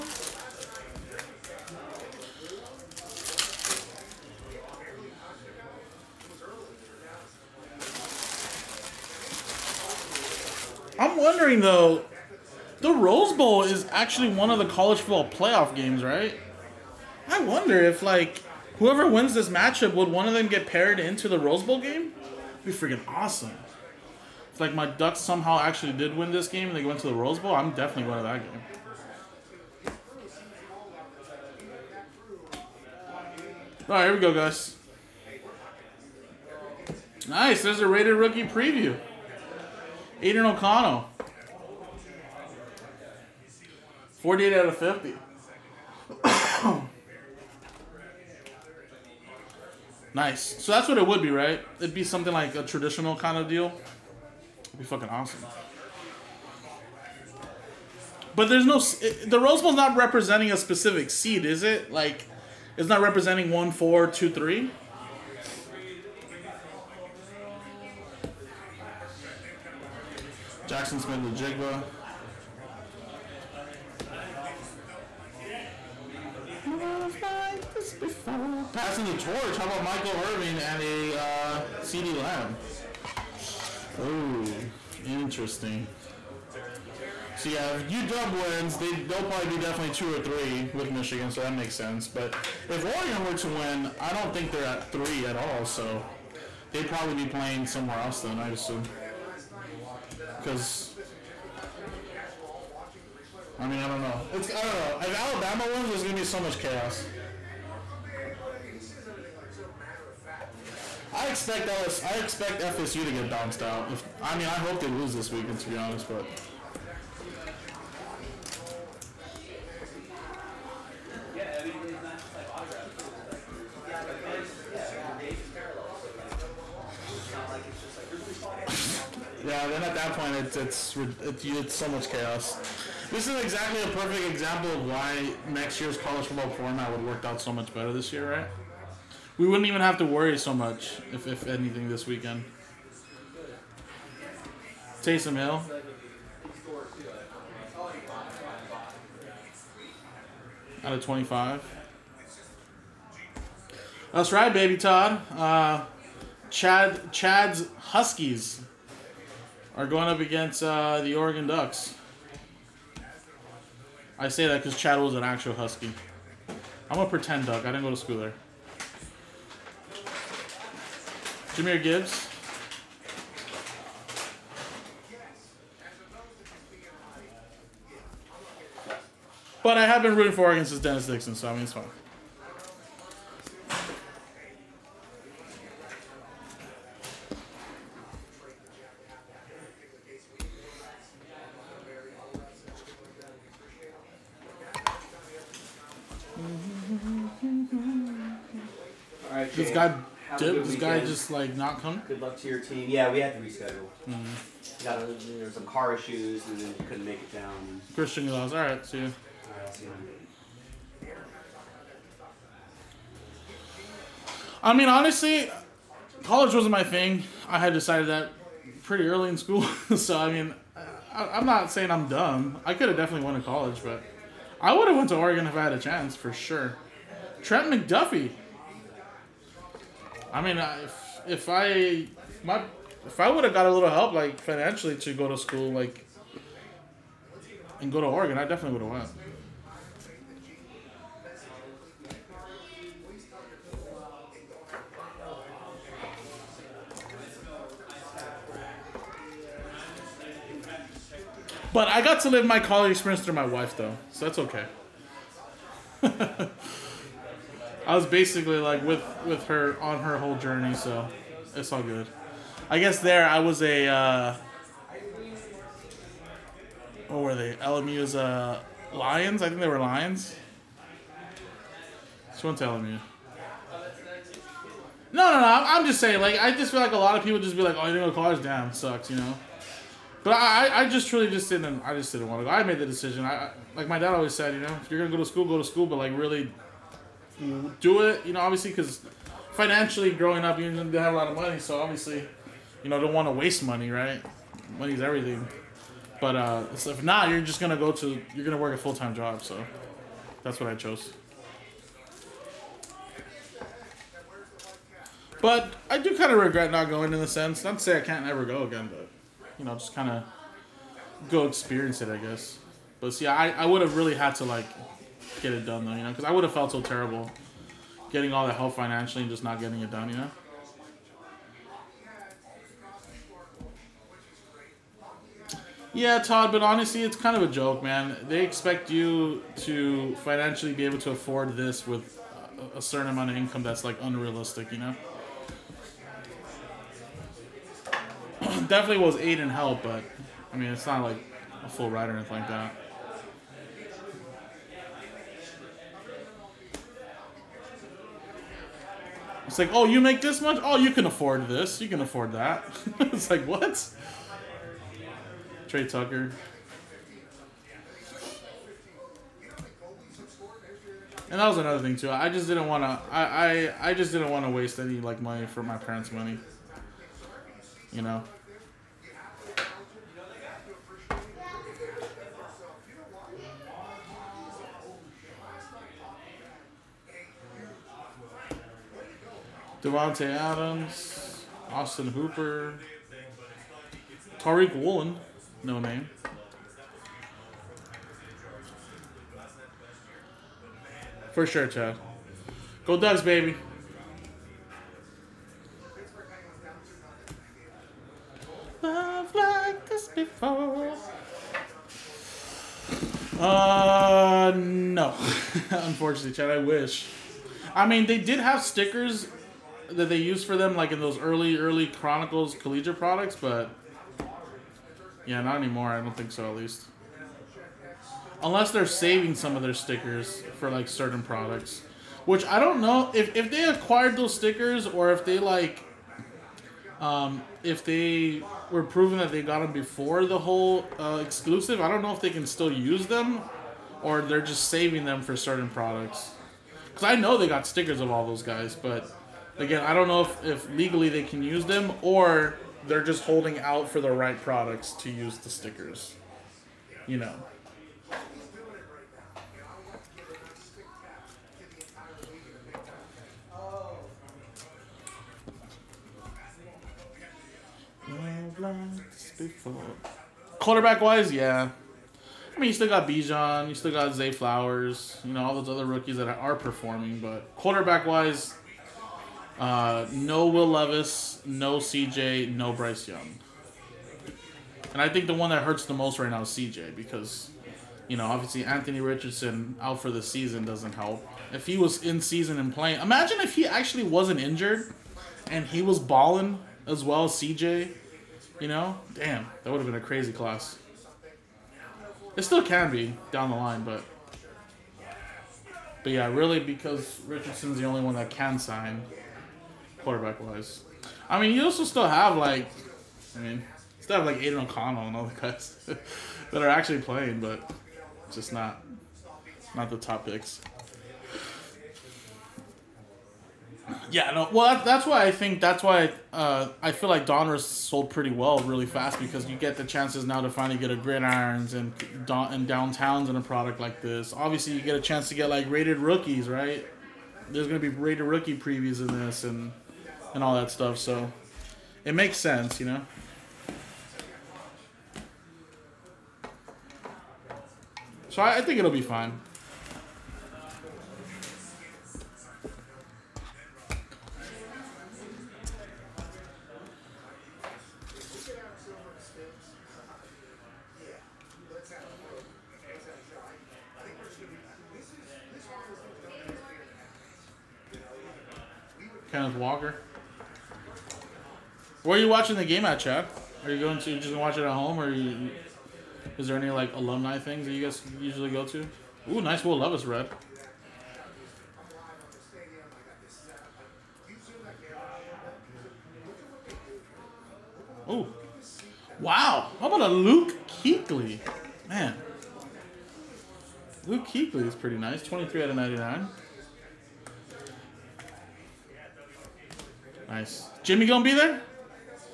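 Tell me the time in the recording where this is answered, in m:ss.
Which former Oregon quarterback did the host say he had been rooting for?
3:00.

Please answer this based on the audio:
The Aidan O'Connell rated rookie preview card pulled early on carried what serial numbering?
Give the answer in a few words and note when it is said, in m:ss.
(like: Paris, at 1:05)
48 out of 50, at 0:44.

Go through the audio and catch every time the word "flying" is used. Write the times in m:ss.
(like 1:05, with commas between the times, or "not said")
not said.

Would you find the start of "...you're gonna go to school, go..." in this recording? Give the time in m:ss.
4:44.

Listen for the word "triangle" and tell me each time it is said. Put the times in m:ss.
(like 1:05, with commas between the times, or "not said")
not said.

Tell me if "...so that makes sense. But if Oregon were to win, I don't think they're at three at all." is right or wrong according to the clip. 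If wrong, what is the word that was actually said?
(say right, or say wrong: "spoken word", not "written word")
right.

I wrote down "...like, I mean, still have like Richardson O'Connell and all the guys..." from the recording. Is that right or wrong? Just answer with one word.
wrong.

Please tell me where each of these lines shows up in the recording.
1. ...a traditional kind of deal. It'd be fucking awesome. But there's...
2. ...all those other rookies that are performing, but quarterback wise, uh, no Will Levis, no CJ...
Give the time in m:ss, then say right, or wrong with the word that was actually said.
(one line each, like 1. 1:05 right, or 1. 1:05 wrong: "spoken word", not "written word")
1. 0:52 right
2. 7:45 right.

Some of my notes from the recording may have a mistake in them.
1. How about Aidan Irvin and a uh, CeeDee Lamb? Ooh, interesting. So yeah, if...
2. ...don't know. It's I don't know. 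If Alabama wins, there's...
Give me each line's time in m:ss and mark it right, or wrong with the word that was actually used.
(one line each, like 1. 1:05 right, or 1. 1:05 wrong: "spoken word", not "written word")
1. 1:19 wrong: "Michael", not "Aidan"
2. 1:43 right.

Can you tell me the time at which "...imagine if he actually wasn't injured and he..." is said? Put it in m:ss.
8:03.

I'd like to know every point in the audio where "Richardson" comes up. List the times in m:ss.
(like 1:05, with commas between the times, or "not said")
7:59, 8:17.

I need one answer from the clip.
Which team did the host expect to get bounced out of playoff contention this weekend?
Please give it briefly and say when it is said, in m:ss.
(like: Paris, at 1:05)
FSU, at 1:52.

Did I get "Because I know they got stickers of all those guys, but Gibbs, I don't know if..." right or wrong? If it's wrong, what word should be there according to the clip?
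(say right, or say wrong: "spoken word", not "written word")
wrong: "Again", not "Gibbs".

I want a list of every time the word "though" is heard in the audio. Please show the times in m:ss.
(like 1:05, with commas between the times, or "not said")
0:11, 4:13, 5:15.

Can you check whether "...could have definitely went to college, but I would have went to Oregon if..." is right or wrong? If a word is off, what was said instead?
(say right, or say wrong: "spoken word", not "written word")
right.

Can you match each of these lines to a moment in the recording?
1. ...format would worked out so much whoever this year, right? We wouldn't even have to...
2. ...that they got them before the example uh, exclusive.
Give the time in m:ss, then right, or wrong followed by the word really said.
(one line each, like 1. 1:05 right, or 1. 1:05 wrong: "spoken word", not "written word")
1. 2:16 wrong: "better", not "whoever"
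2. 7:09 wrong: "whole", not "example".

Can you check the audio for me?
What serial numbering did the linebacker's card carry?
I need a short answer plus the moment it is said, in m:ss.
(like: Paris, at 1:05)
23 out of 99, at 9:45.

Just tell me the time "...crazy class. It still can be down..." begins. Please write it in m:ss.
8:10.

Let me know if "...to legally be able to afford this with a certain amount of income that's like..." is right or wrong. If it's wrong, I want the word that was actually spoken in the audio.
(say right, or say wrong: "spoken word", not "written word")
wrong: "financially", not "legally".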